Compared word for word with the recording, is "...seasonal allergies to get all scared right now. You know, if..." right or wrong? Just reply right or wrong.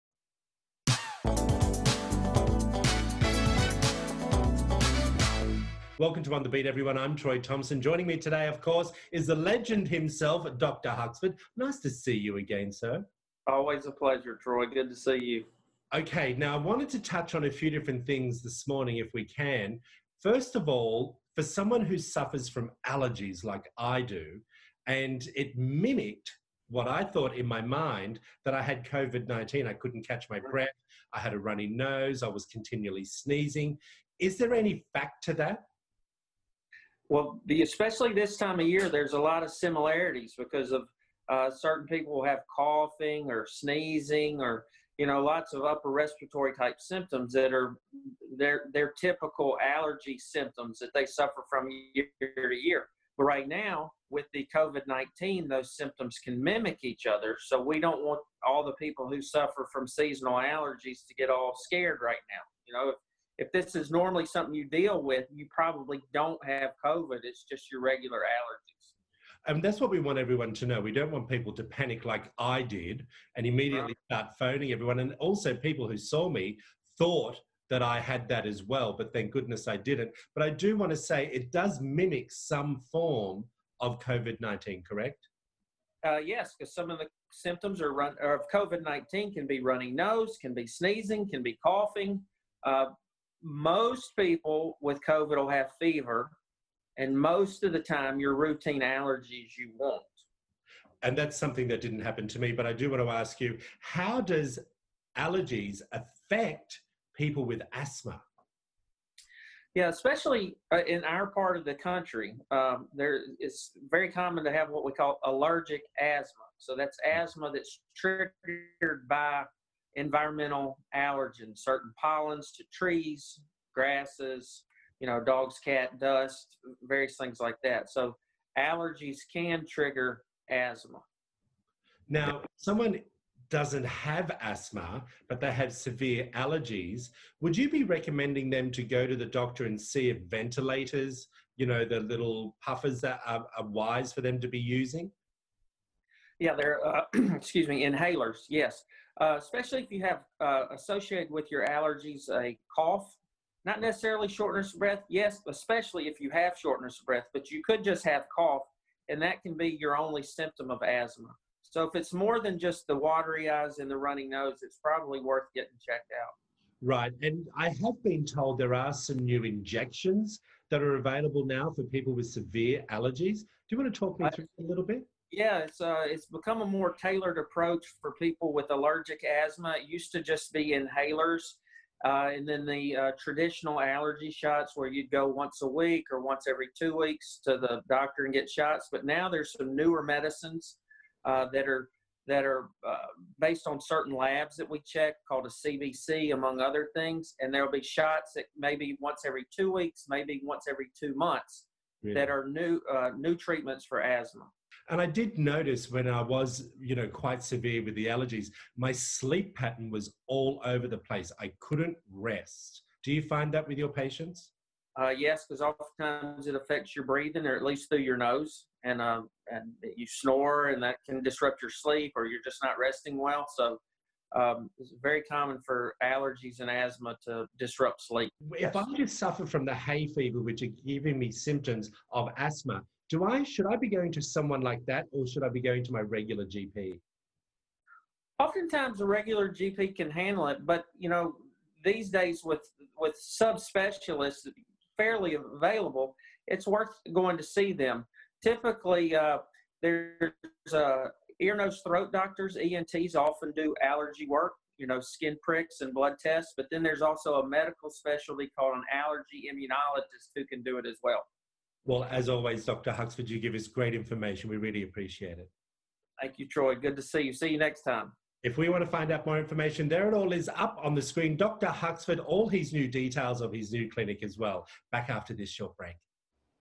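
right.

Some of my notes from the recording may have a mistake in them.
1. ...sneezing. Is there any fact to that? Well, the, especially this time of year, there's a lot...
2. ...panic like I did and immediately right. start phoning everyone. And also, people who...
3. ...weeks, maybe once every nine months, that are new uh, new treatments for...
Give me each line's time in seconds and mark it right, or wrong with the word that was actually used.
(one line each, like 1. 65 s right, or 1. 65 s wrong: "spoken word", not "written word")
1. 33 s right
2. 71 s right
3. 199 s wrong: "two", not "nine".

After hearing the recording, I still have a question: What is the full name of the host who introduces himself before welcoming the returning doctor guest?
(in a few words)
Troy Thompson.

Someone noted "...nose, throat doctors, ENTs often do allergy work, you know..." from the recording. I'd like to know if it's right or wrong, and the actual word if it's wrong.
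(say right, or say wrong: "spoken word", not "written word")
right.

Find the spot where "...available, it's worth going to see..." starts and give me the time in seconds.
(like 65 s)
245 s.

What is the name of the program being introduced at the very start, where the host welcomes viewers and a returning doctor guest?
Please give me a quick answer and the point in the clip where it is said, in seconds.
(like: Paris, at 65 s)
On the Beat, at 6 s.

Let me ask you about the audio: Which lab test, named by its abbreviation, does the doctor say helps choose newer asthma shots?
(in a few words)
CBC.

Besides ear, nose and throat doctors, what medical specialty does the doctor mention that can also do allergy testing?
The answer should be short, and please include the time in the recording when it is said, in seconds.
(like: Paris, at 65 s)
Allergy immunologist, at 258 s.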